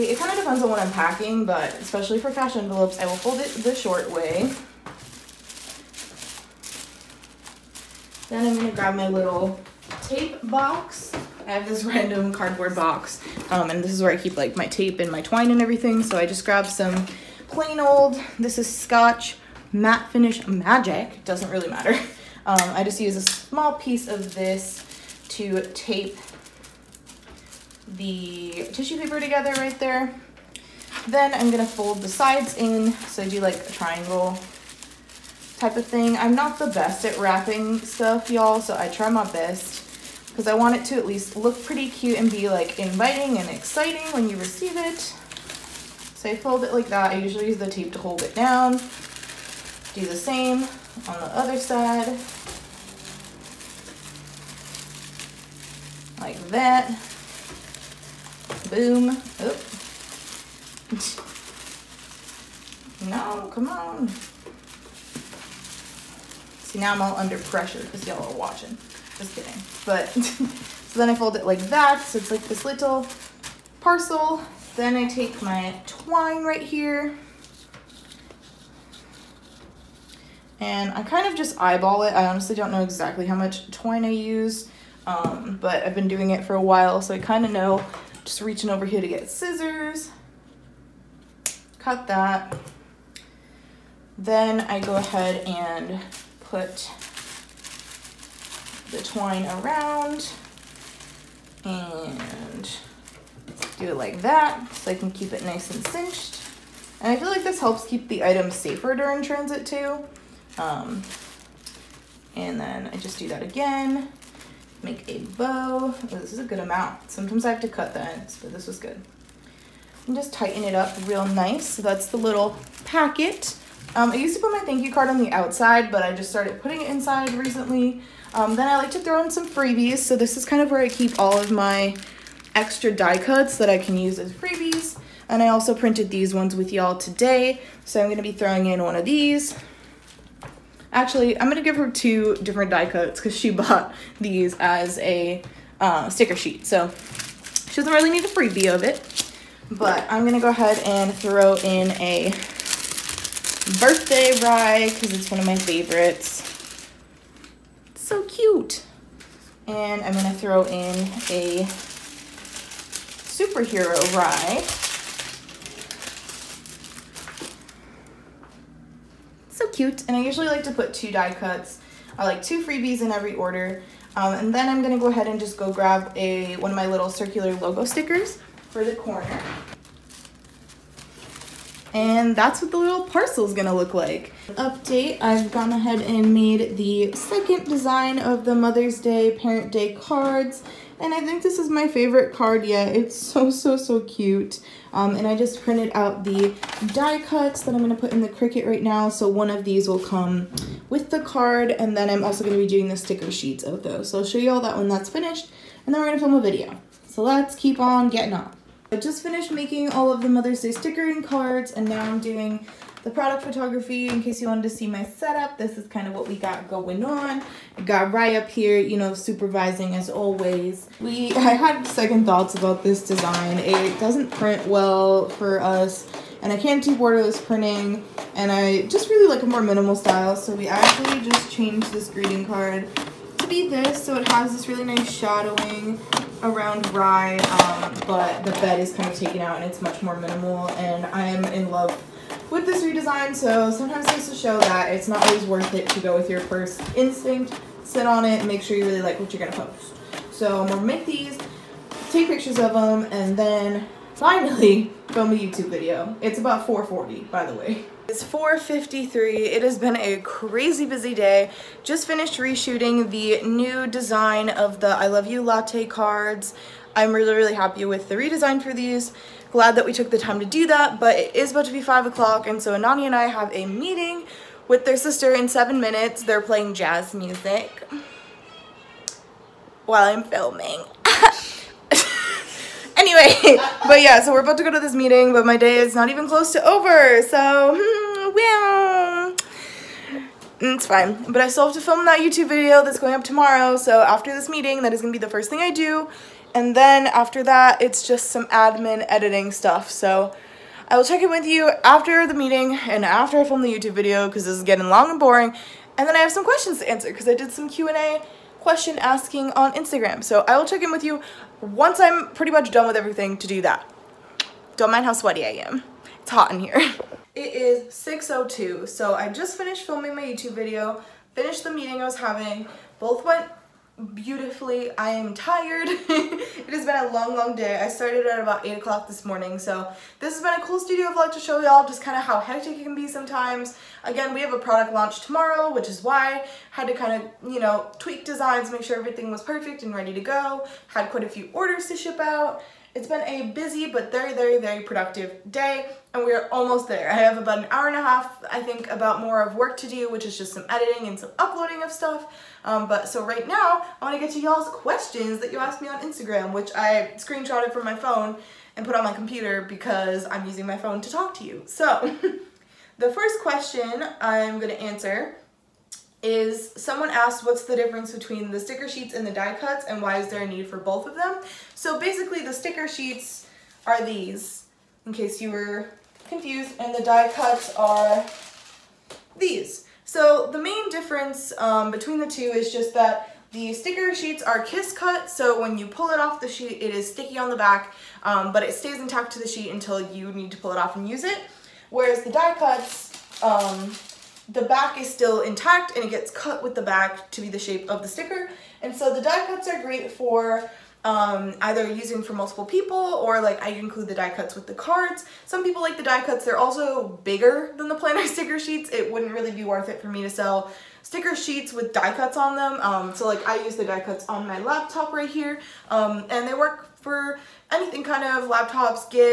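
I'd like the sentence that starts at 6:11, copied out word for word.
So basically the sticker sheets are these, in case you were confused, and the die cuts are these.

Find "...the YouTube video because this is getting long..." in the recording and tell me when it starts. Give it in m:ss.
5:03.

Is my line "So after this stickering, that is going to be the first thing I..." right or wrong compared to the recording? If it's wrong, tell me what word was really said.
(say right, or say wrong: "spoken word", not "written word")
wrong: "meeting", not "stickering".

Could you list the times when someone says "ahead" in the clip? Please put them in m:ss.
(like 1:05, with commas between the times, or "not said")
1:34, 2:30, 2:55, 3:05.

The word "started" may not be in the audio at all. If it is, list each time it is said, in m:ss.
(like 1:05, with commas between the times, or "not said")
2:06, 5:27.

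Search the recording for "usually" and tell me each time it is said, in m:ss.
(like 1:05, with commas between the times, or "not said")
0:47, 2:50.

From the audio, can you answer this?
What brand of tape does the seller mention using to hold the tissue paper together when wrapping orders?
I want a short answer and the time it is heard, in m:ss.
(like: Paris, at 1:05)
Scotch, at 0:18.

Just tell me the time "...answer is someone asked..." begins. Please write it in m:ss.
6:04.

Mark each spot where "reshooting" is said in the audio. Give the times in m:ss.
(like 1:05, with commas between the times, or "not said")
4:22.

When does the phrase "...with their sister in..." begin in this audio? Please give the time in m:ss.
4:34.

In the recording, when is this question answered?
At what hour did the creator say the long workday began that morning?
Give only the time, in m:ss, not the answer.
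5:28.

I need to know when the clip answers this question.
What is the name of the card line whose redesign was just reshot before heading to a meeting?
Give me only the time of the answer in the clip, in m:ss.
4:24.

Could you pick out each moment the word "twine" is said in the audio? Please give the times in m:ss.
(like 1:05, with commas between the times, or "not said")
0:15, 1:15, 1:23, 1:39.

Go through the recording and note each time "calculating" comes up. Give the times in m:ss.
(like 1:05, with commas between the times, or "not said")
not said.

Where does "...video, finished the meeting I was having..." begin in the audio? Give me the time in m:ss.
5:20.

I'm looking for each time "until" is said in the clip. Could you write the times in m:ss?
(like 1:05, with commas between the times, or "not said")
6:29.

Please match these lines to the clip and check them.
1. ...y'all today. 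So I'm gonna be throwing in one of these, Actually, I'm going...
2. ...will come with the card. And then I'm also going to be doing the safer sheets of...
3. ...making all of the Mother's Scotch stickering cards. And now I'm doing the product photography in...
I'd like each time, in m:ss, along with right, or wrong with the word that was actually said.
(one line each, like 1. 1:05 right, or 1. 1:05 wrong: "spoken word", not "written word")
1. 2:16 right
2. 3:19 wrong: "sticker", not "safer"
3. 3:29 wrong: "Day", not "Scotch".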